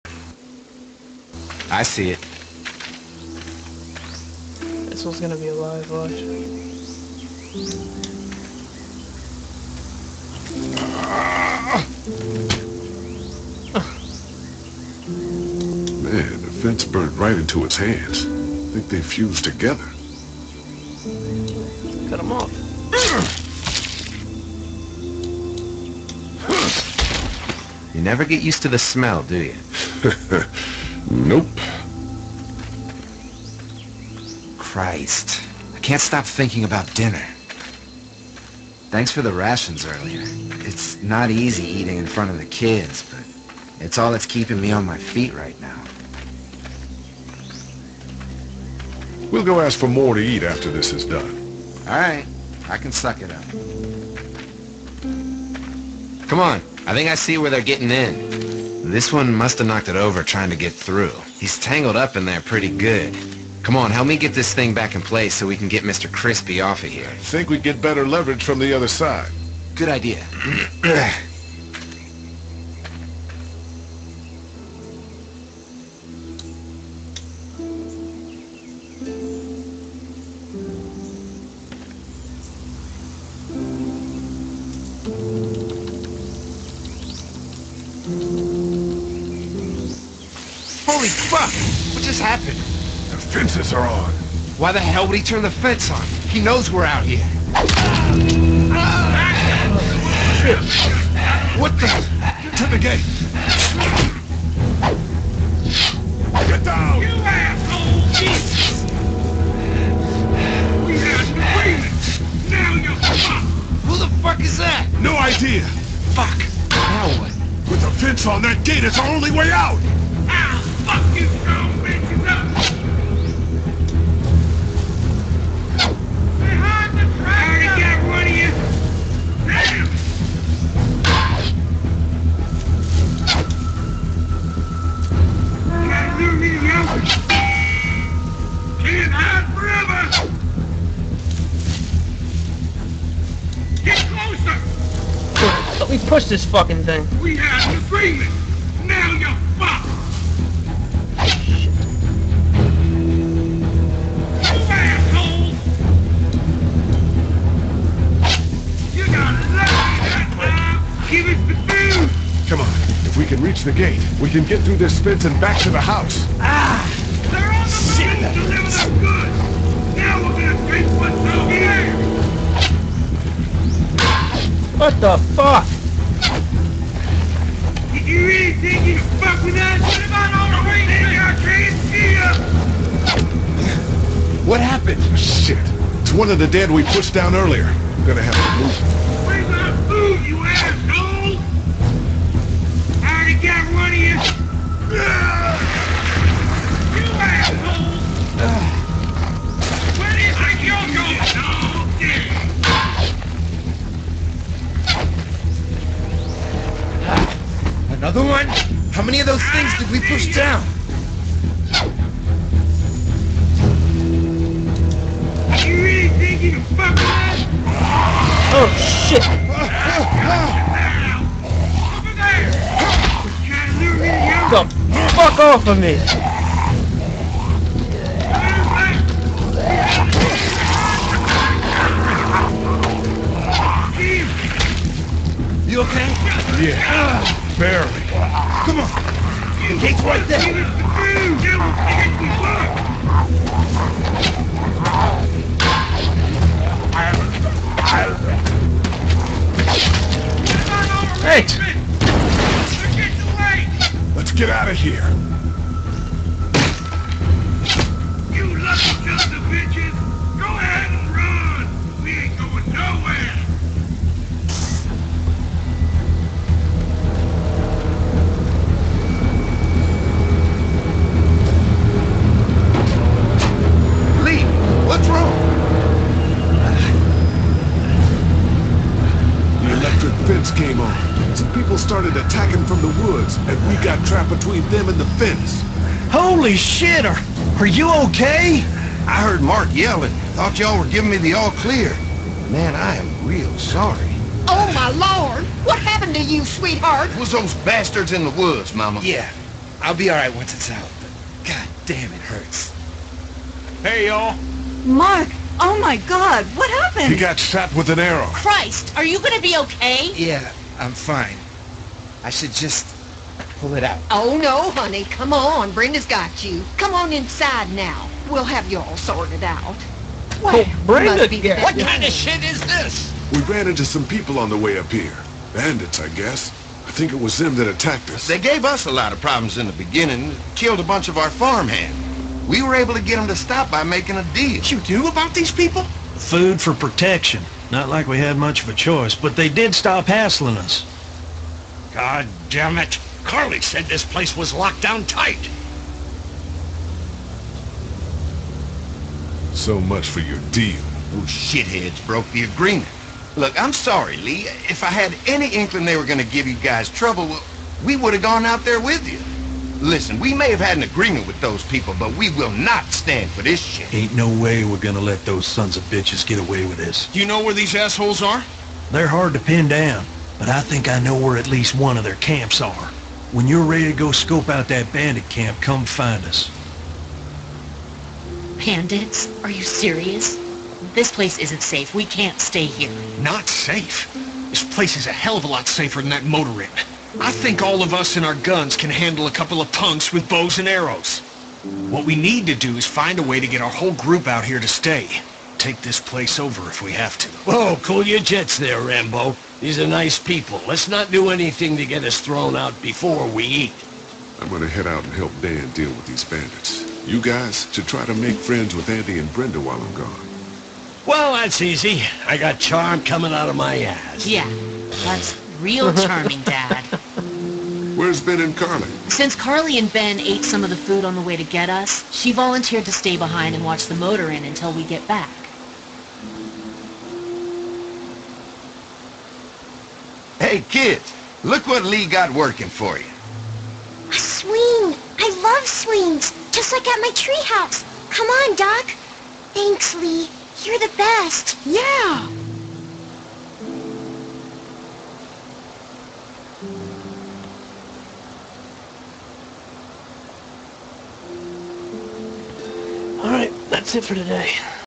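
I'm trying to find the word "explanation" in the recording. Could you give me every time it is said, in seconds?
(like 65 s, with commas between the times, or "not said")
not said.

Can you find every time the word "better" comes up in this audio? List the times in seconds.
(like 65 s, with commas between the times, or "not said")
67 s.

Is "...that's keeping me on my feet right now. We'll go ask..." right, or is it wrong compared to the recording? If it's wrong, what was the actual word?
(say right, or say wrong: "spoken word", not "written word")
right.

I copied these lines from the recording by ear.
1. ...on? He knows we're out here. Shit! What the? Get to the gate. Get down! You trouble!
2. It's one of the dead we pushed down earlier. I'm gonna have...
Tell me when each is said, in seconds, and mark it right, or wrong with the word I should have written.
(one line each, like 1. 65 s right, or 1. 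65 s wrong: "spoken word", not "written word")
1. 95 s wrong: "asshole", not "trouble"
2. 186 s right.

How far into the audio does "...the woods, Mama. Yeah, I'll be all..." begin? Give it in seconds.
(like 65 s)
298 s.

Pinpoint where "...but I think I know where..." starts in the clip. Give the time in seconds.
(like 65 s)
370 s.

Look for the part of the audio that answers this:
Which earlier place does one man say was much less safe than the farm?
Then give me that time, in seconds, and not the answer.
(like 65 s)
386 s.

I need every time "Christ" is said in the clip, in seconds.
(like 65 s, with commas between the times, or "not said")
34 s, 308 s.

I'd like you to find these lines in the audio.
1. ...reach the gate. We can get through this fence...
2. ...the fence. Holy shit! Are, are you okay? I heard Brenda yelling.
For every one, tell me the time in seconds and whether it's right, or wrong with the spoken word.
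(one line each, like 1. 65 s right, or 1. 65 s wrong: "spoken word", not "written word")
1. 163 s right
2. 284 s wrong: "Mark", not "Brenda".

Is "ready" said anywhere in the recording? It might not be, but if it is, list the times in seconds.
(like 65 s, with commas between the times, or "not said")
373 s.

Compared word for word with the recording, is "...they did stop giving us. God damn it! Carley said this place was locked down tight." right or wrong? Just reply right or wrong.
wrong.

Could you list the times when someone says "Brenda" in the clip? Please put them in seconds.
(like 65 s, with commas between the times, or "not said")
315 s, 320 s, 409 s.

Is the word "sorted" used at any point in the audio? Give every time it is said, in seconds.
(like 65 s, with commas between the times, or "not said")
318 s.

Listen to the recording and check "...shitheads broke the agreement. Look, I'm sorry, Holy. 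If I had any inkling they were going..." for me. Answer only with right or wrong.
wrong.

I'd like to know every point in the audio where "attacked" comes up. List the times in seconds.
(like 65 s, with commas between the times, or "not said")
327 s.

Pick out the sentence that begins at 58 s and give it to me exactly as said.
This one must have knocked it over trying to get through.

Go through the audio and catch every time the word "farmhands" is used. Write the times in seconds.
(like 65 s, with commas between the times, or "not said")
331 s.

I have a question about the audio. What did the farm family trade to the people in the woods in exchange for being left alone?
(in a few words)
Food for protection.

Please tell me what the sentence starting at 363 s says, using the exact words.
Ain't no way we're gonna let those sons of bitches get away with this.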